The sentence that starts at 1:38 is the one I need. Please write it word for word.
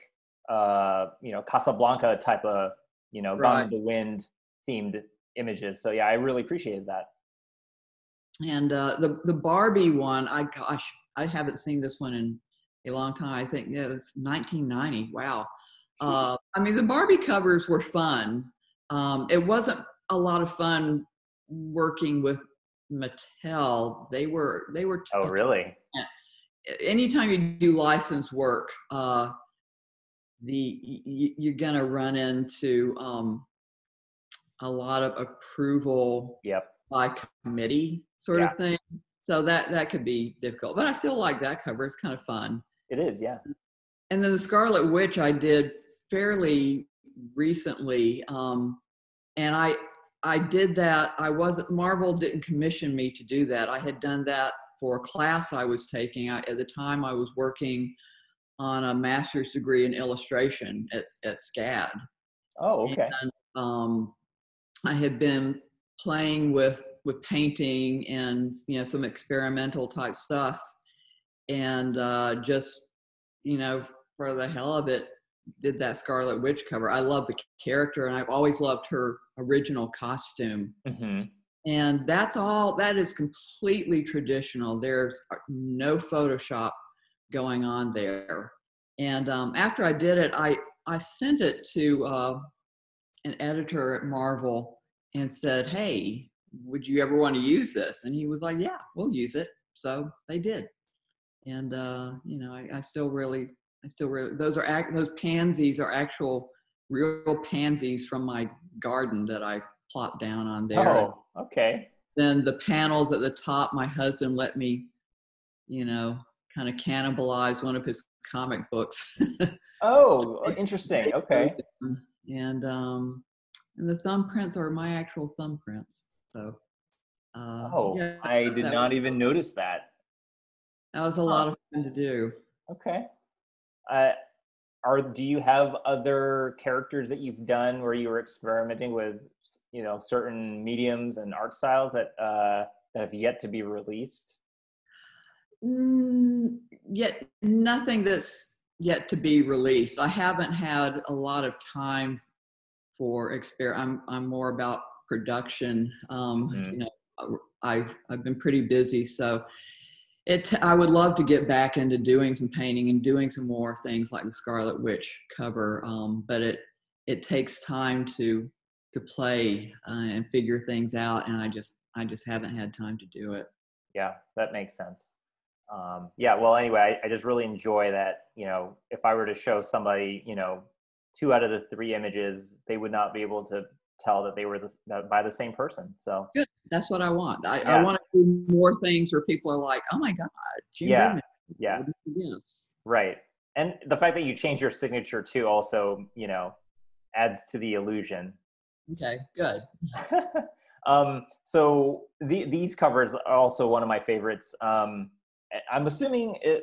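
And he was like, Yeah, we'll use it.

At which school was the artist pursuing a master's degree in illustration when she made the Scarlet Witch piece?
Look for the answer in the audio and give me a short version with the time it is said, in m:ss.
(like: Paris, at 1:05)
SCAD, at 1:01.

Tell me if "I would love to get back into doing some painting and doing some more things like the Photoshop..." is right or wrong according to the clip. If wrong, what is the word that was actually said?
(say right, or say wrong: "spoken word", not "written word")
wrong: "Scarlet", not "Photoshop".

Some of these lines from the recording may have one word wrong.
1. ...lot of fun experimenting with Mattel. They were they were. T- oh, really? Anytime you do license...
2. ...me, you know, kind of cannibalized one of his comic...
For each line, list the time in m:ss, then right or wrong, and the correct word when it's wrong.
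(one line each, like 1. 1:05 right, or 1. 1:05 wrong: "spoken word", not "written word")
1. 0:20 wrong: "working", not "experimenting"
2. 1:54 right.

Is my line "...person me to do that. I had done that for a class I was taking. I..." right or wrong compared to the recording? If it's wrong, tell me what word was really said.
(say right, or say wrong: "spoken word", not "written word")
wrong: "commission", not "person".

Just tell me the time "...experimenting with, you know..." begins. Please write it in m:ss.
2:18.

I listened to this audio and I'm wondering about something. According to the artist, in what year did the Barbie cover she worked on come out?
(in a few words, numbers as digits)
1990.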